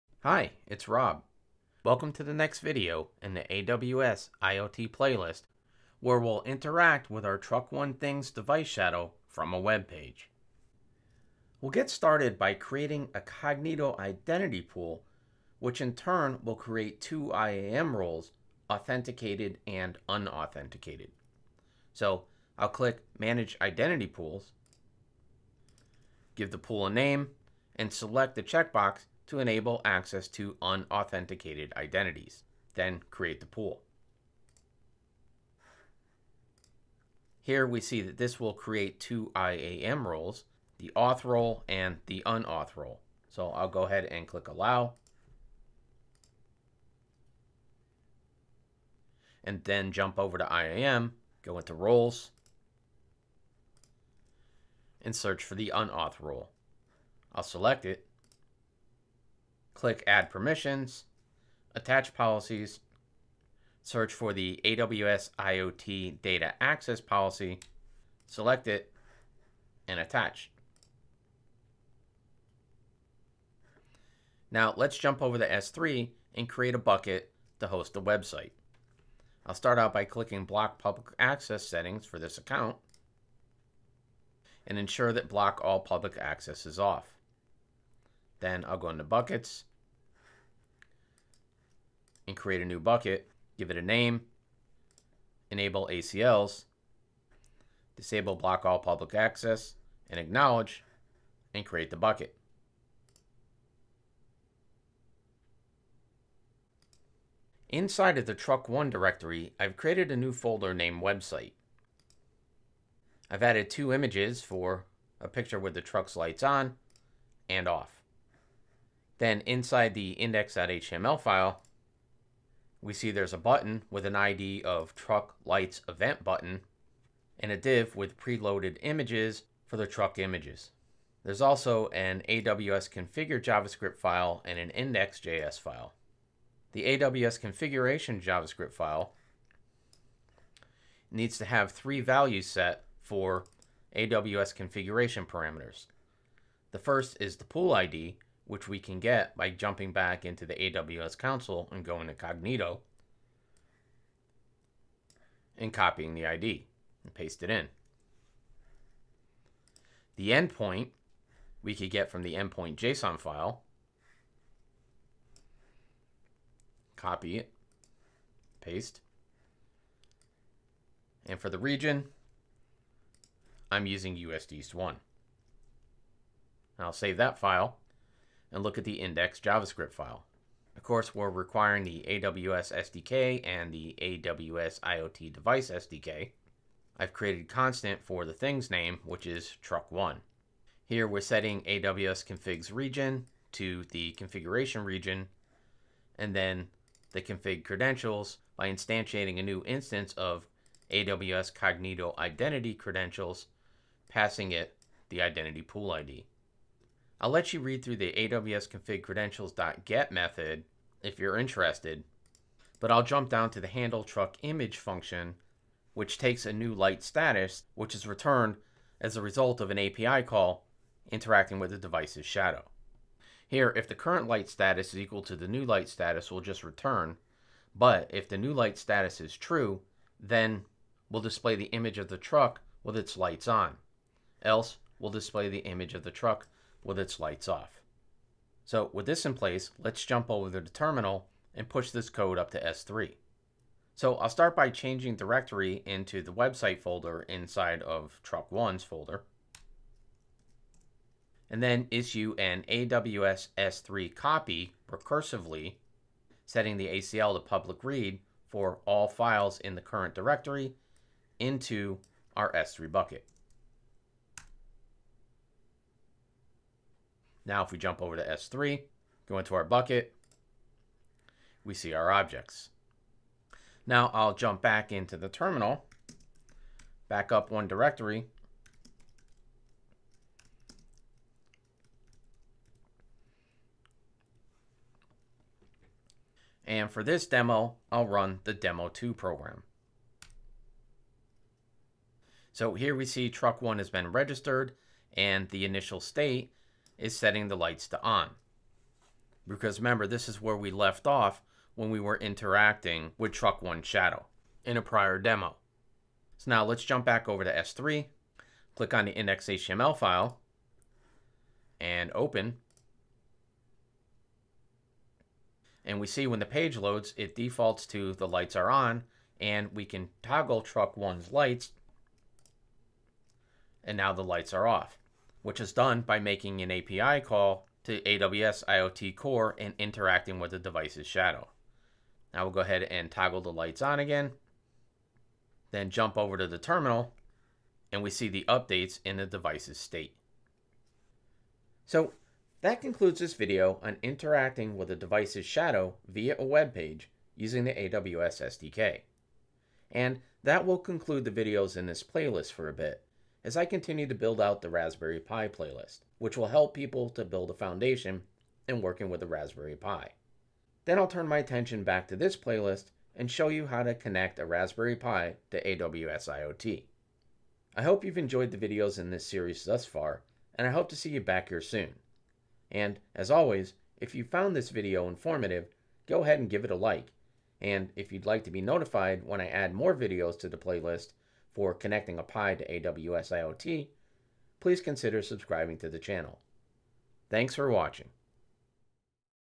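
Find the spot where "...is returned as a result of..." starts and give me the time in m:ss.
3:37.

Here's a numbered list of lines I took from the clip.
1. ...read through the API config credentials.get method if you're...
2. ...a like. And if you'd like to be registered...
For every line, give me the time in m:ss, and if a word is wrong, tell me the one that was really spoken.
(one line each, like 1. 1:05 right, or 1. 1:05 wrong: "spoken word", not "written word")
1. 3:27 wrong: "AWS", not "API"
2. 6:16 wrong: "notified", not "registered".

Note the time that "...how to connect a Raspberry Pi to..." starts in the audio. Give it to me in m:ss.
6:03.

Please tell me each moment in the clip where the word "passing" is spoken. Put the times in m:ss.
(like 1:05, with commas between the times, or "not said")
3:24.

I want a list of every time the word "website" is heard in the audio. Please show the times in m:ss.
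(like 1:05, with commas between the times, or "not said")
1:18, 1:51, 4:06.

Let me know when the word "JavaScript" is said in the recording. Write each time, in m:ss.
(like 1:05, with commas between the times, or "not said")
2:13, 2:18, 2:59.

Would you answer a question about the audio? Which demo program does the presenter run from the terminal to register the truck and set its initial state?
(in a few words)
demo2.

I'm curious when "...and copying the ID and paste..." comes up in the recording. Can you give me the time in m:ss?
2:35.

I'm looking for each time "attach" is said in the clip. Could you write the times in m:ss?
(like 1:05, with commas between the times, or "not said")
1:01, 1:09.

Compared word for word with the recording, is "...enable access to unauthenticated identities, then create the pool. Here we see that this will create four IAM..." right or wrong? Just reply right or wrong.
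wrong.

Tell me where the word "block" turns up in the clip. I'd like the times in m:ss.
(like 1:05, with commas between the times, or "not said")
1:20, 1:25, 1:38.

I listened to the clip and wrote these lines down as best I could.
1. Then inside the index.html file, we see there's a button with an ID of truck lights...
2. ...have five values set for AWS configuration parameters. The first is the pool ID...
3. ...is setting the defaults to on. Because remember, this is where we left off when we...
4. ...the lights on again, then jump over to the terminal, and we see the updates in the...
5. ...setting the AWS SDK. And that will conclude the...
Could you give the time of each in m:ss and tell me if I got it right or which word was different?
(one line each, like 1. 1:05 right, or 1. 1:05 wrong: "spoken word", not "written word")
1. 1:59 right
2. 2:21 wrong: "three", not "five"
3. 4:57 wrong: "lights", not "defaults"
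4. 5:33 right
5. 5:47 wrong: "using", not "setting".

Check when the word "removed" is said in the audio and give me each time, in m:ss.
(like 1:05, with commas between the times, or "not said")
not said.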